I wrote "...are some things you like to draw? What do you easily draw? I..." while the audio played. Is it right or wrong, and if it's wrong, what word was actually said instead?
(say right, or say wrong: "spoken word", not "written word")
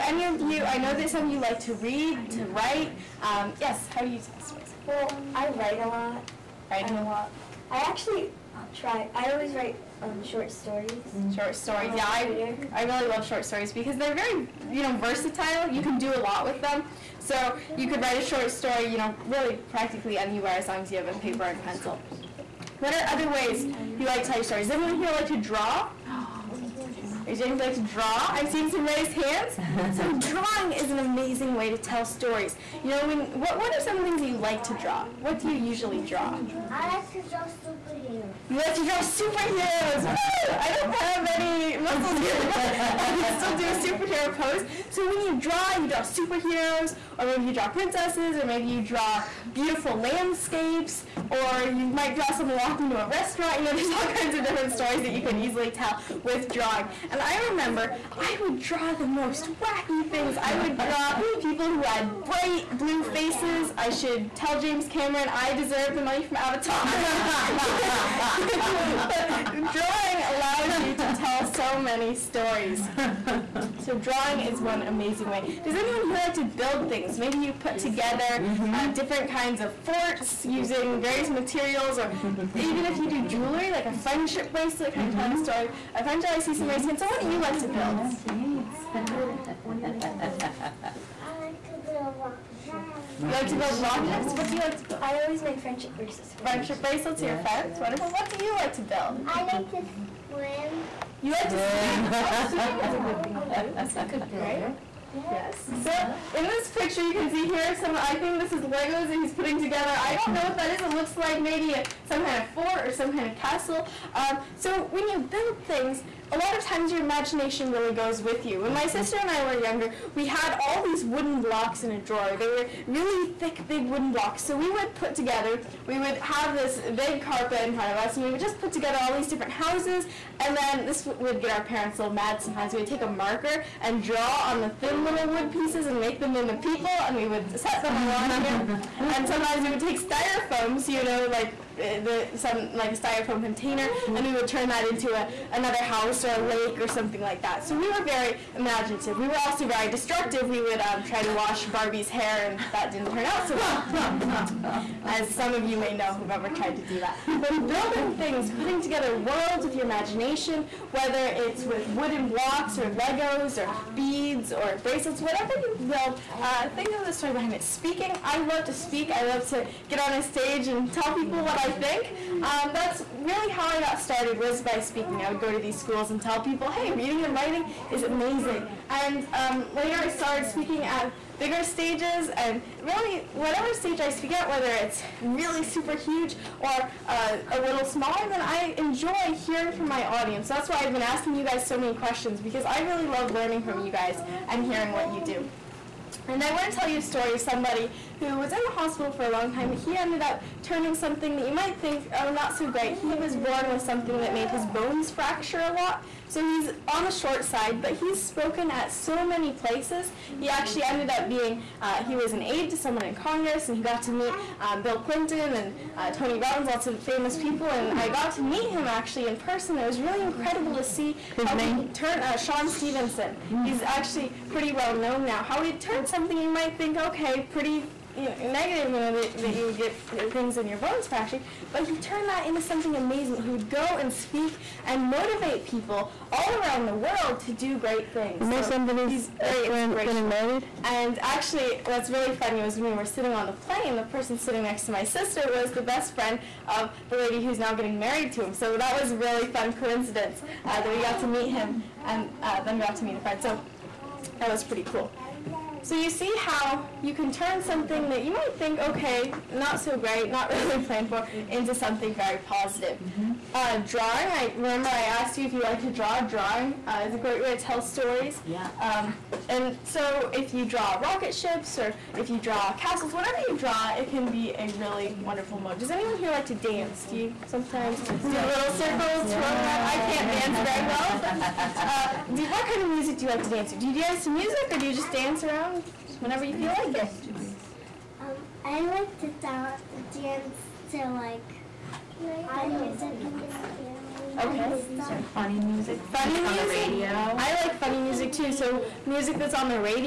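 wrong: "usually", not "easily".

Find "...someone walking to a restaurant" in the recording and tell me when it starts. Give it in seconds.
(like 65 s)
52 s.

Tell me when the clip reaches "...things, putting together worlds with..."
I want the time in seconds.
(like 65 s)
158 s.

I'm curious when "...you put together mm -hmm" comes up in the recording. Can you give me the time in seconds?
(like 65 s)
77 s.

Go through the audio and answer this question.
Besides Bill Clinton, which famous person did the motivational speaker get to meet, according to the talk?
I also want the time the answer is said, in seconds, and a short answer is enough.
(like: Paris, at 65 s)
Tony Robbins, at 216 s.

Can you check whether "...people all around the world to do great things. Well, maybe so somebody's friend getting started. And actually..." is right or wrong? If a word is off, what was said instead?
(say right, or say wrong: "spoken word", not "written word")
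wrong: "married", not "started".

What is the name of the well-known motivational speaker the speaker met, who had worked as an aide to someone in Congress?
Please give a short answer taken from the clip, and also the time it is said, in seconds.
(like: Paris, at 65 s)
Sean Stephenson, at 222 s.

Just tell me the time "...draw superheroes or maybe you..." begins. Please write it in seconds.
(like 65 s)
45 s.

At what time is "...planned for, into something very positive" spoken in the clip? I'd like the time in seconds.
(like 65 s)
260 s.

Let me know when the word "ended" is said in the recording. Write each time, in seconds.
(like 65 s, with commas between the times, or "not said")
199 s, 210 s.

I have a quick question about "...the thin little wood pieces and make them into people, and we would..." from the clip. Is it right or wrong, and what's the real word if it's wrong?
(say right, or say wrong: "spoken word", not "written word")
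right.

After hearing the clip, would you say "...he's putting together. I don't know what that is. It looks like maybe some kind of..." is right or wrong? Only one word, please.
right.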